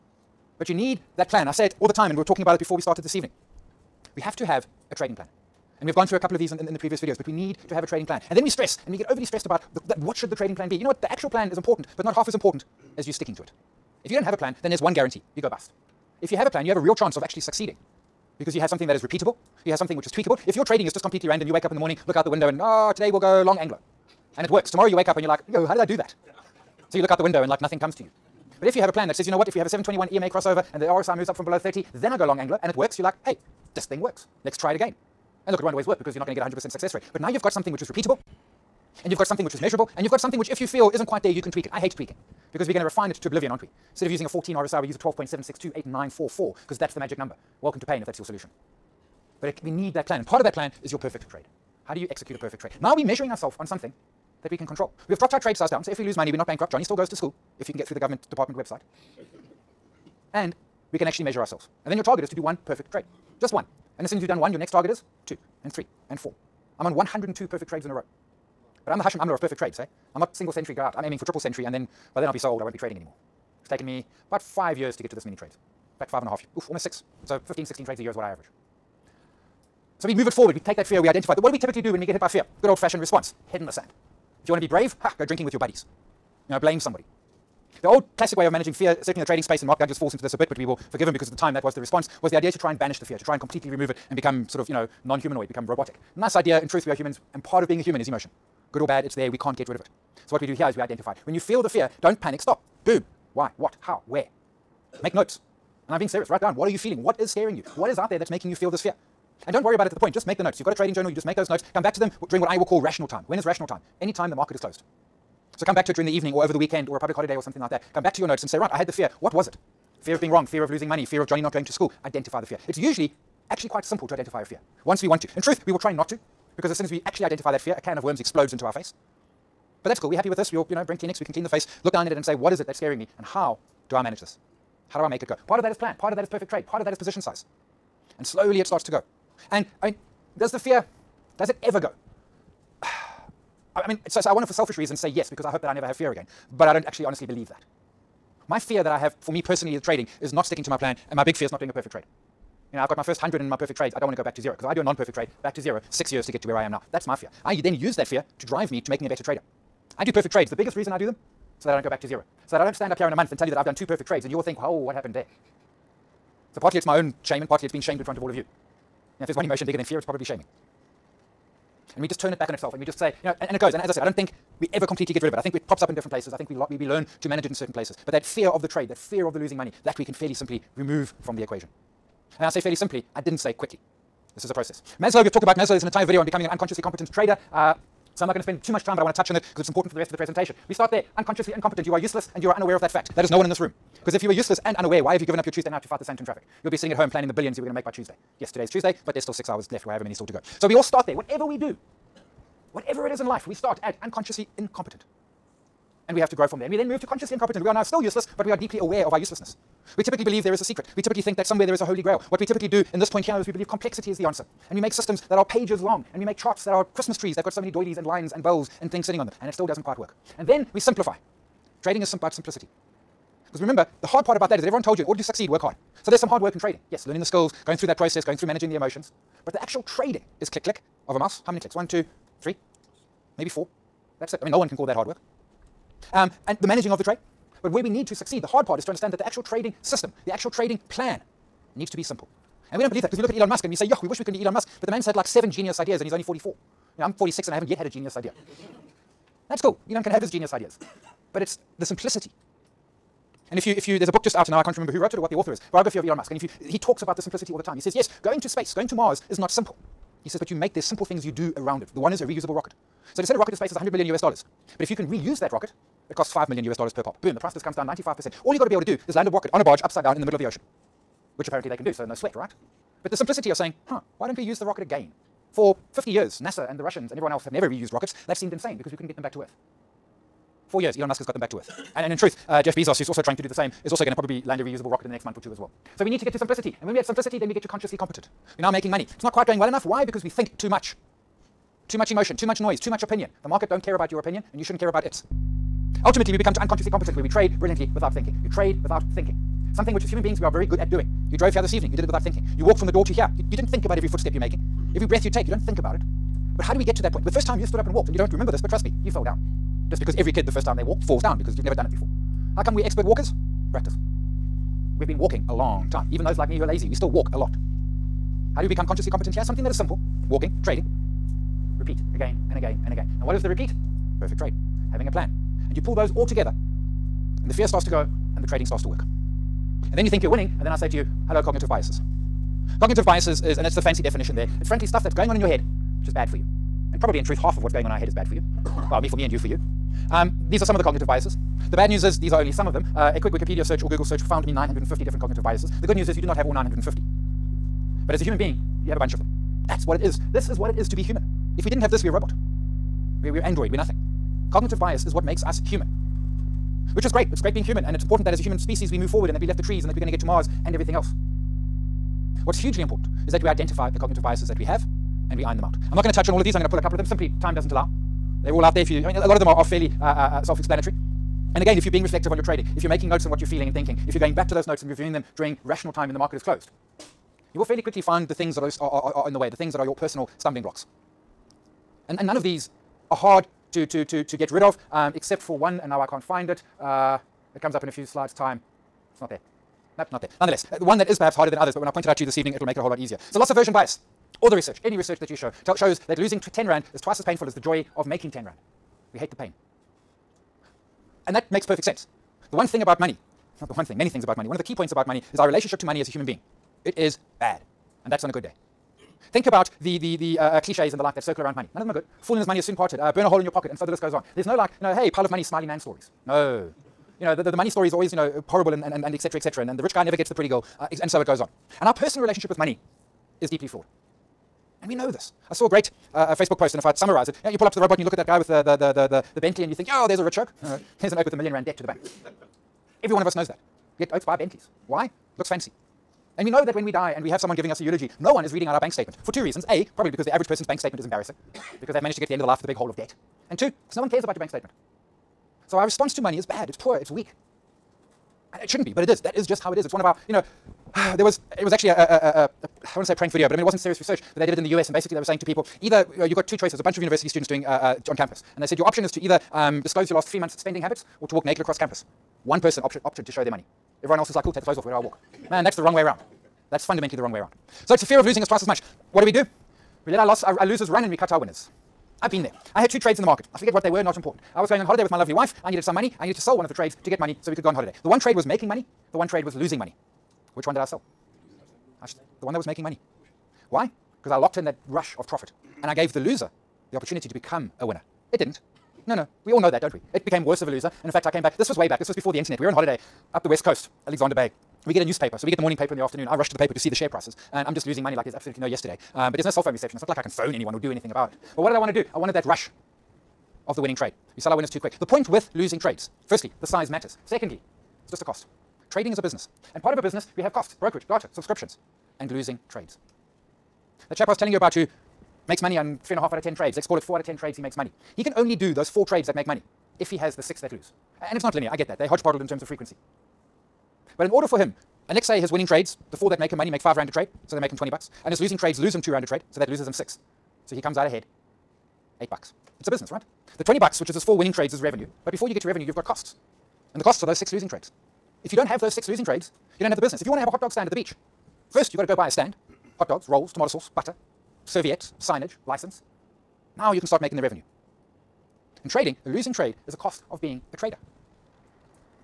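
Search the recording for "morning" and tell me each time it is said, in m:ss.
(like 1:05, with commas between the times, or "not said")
0:21, 8:15.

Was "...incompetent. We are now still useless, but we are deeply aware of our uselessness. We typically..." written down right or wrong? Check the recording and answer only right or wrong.
right.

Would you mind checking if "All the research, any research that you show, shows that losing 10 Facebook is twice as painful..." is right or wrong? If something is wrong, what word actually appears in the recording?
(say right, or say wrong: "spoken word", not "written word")
wrong: "Rand", not "Facebook".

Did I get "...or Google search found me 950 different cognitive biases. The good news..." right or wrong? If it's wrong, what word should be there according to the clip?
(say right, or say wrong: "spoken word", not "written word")
right.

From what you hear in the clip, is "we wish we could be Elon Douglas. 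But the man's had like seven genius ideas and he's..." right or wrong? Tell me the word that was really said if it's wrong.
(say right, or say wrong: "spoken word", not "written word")
wrong: "Musk", not "Douglas".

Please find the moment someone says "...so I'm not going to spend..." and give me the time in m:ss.
3:08.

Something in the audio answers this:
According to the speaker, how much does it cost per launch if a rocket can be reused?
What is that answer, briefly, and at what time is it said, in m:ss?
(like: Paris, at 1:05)
5 million US dollars, at 4:26.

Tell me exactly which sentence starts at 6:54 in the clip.
There's no like, you know, hey, pile of money, smiley man stories.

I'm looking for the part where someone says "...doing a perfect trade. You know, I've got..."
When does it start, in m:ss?
2:31.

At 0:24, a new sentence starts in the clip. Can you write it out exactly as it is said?
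Tomorrow you wake up and you're like, yo, how did I do that?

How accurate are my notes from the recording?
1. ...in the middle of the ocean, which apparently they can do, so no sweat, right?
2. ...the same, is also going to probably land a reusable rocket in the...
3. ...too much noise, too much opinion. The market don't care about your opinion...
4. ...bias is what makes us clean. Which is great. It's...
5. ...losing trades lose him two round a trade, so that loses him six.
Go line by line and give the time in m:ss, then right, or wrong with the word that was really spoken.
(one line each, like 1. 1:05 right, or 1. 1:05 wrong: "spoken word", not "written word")
1. 4:30 right
2. 4:43 right
3. 4:52 right
4. 5:54 wrong: "human", not "clean"
5. 8:48 right.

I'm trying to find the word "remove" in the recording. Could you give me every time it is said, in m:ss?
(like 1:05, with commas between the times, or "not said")
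1:33, 3:00.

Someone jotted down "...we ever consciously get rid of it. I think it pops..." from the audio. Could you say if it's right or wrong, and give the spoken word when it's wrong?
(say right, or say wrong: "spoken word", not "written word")
wrong: "completely", not "consciously".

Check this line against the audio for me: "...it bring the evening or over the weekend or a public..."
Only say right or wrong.
wrong.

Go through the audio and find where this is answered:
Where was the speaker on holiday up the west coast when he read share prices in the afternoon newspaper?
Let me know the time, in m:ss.
8:14.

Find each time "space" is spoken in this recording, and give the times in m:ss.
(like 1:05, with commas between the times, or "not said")
1:29, 4:18, 4:23.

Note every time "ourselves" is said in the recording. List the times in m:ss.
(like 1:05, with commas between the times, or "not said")
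0:53, 1:01.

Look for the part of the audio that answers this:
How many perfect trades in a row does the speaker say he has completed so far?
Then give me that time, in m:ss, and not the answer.
1:06.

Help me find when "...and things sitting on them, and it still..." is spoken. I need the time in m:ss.
3:38.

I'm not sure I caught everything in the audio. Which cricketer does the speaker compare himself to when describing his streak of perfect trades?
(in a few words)
Hashim Amla.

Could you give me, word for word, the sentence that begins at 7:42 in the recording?
One person opted to show their money.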